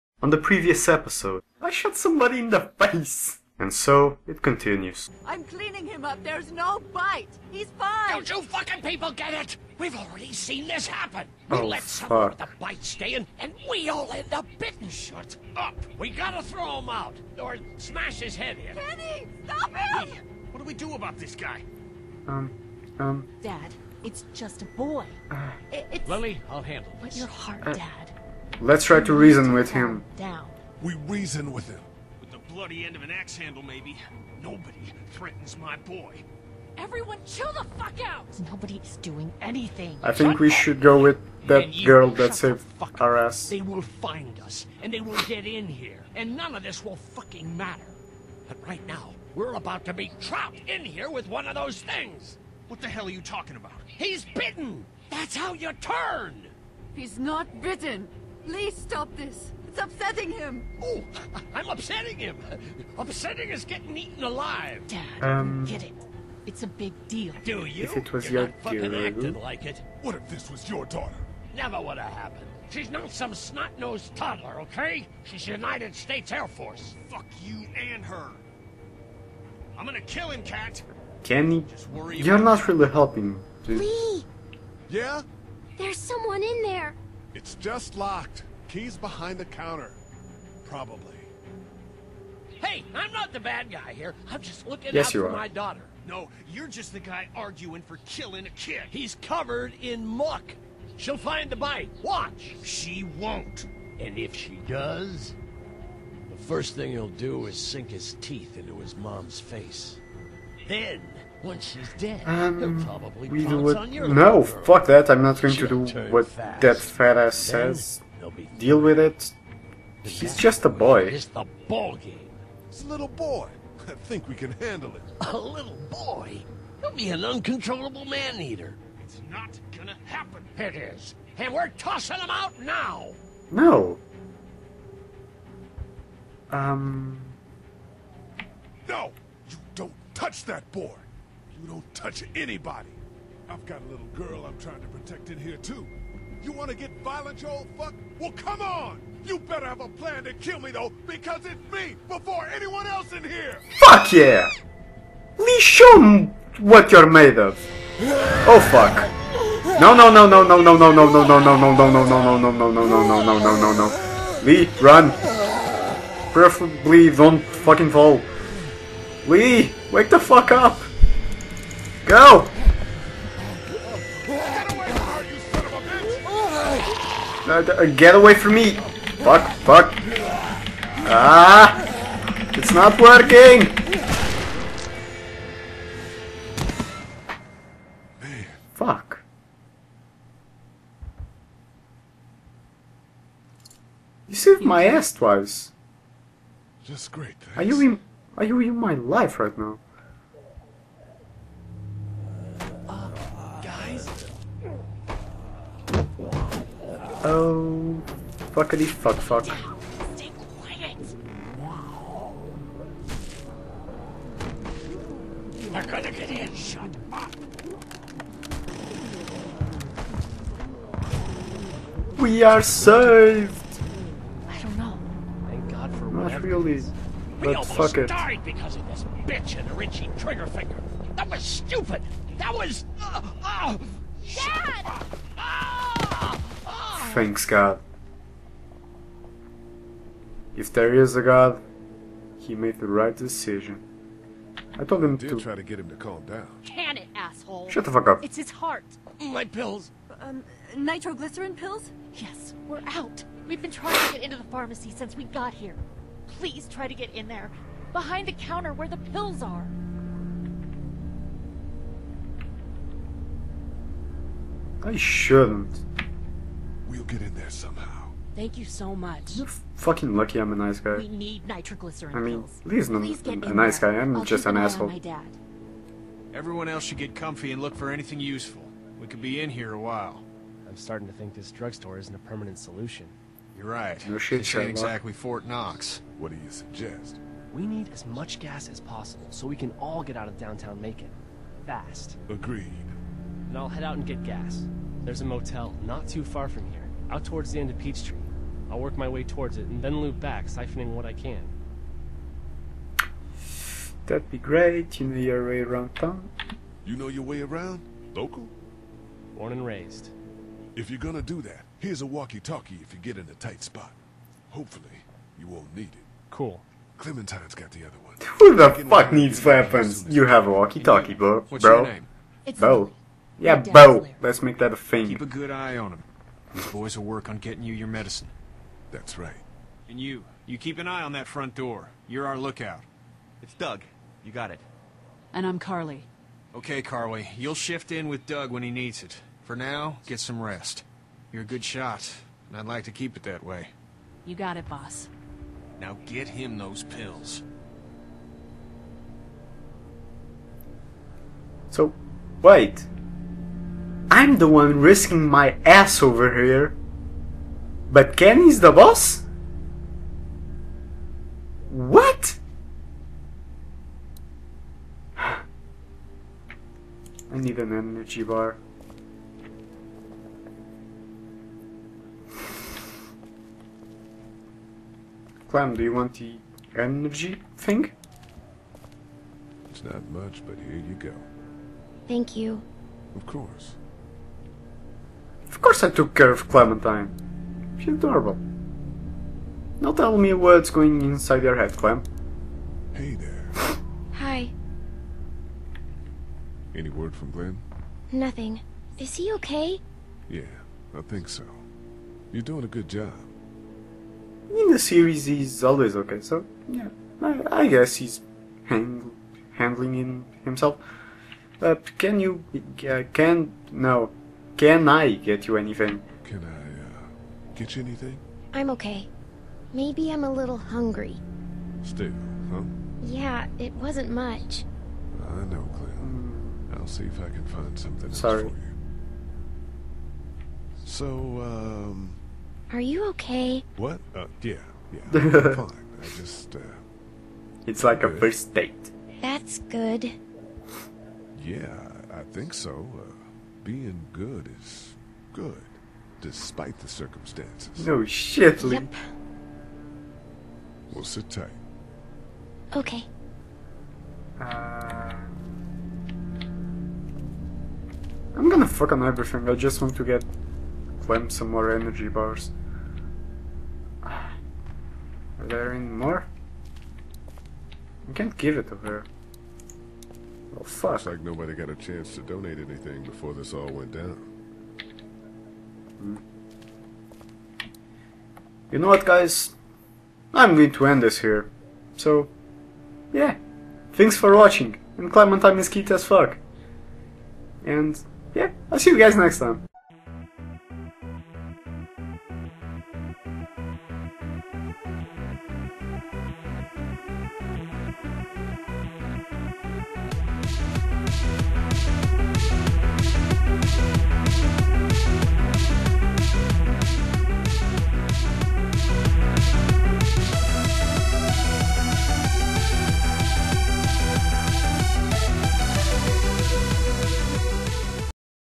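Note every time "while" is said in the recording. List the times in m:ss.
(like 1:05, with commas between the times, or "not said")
4:39.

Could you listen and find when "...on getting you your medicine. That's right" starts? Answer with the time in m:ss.
5:27.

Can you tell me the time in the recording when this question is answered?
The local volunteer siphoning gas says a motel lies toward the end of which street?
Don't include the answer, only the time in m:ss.
4:57.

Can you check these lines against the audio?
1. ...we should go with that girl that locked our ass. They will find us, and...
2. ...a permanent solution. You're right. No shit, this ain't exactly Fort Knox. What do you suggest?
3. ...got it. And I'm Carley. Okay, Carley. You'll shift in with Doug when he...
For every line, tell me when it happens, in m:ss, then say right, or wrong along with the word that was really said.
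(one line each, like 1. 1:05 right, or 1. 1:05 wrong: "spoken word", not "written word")
1. 0:40 wrong: "saved", not "locked"
2. 4:42 right
3. 5:34 right.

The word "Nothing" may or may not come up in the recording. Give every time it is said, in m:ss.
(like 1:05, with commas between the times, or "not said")
6:38.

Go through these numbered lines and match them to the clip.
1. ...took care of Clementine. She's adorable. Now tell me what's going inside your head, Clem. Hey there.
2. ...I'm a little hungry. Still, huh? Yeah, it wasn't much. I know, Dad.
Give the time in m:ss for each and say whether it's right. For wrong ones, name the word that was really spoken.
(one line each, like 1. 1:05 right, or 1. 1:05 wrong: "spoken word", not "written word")
1. 6:25 right
2. 7:00 wrong: "Clem", not "Dad".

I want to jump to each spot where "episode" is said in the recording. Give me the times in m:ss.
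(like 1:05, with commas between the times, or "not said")
0:00.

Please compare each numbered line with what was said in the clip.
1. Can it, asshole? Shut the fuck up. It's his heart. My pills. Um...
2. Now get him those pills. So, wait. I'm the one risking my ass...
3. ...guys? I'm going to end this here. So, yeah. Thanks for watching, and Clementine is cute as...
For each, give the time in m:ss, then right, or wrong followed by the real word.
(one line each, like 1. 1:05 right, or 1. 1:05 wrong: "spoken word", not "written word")
1. 4:06 right
2. 5:45 right
3. 7:59 right.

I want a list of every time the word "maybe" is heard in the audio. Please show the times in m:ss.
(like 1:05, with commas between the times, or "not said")
0:33, 6:59.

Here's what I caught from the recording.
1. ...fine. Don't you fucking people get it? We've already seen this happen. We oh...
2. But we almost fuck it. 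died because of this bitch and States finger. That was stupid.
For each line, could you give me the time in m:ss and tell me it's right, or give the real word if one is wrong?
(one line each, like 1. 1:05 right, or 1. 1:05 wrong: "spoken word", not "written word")
1. 0:07 right
2. 3:47 wrong: "Richie", not "States".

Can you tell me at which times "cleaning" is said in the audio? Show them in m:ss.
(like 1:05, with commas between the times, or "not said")
0:05.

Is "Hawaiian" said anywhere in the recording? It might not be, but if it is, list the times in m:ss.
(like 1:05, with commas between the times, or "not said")
not said.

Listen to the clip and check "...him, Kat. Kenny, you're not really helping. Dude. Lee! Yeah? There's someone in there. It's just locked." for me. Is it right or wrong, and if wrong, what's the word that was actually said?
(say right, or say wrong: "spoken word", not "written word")
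right.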